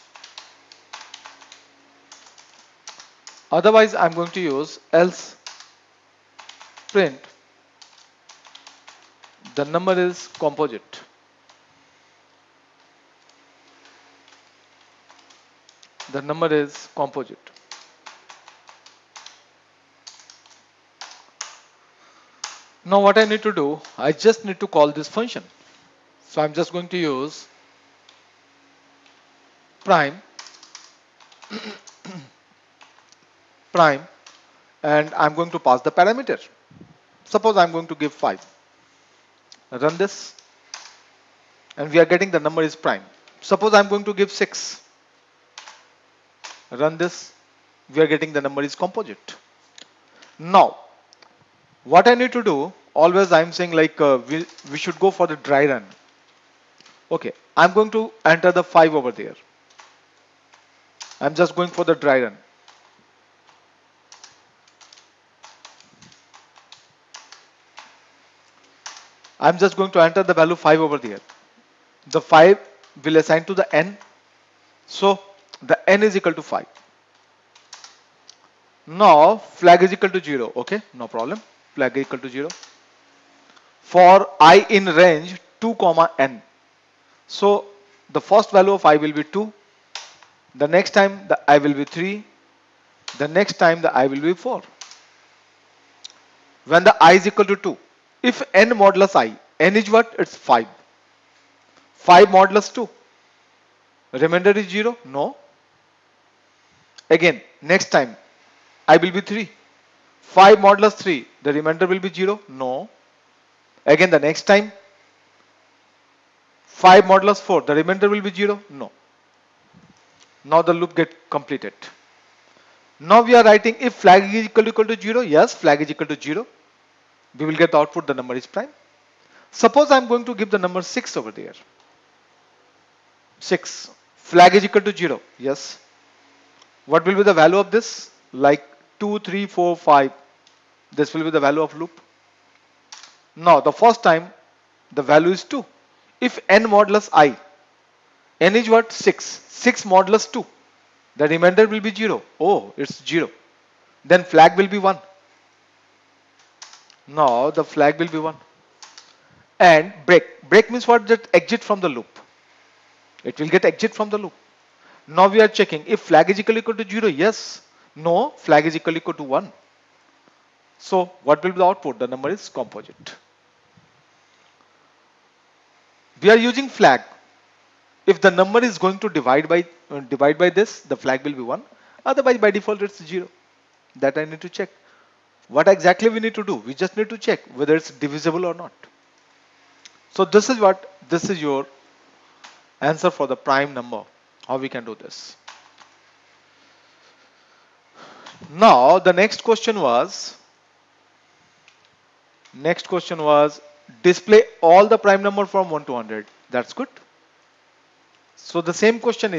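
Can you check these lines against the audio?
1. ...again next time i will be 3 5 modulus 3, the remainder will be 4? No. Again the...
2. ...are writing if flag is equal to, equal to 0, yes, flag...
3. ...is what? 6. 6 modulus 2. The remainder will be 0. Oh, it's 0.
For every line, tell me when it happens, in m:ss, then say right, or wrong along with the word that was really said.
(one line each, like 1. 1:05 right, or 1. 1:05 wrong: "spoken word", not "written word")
1. 1:47 wrong: "0", not "4"
2. 2:03 right
3. 2:28 right.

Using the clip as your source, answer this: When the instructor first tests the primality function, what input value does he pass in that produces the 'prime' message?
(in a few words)
5.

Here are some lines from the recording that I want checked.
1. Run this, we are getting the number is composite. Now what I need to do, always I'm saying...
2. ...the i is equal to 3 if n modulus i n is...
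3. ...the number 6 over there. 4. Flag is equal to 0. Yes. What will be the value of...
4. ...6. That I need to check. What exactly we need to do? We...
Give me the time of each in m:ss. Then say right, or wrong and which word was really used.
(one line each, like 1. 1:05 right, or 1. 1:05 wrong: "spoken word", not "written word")
1. 0:46 right
2. 1:36 wrong: "2", not "3"
3. 2:10 wrong: "6", not "4"
4. 3:03 wrong: "0", not "6".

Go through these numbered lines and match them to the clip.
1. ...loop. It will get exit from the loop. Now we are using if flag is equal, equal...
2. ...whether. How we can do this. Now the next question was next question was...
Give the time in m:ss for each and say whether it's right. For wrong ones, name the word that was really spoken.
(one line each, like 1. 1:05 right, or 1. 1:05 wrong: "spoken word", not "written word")
1. 2:41 wrong: "checking", not "using"
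2. 3:13 wrong: "number", not "whether".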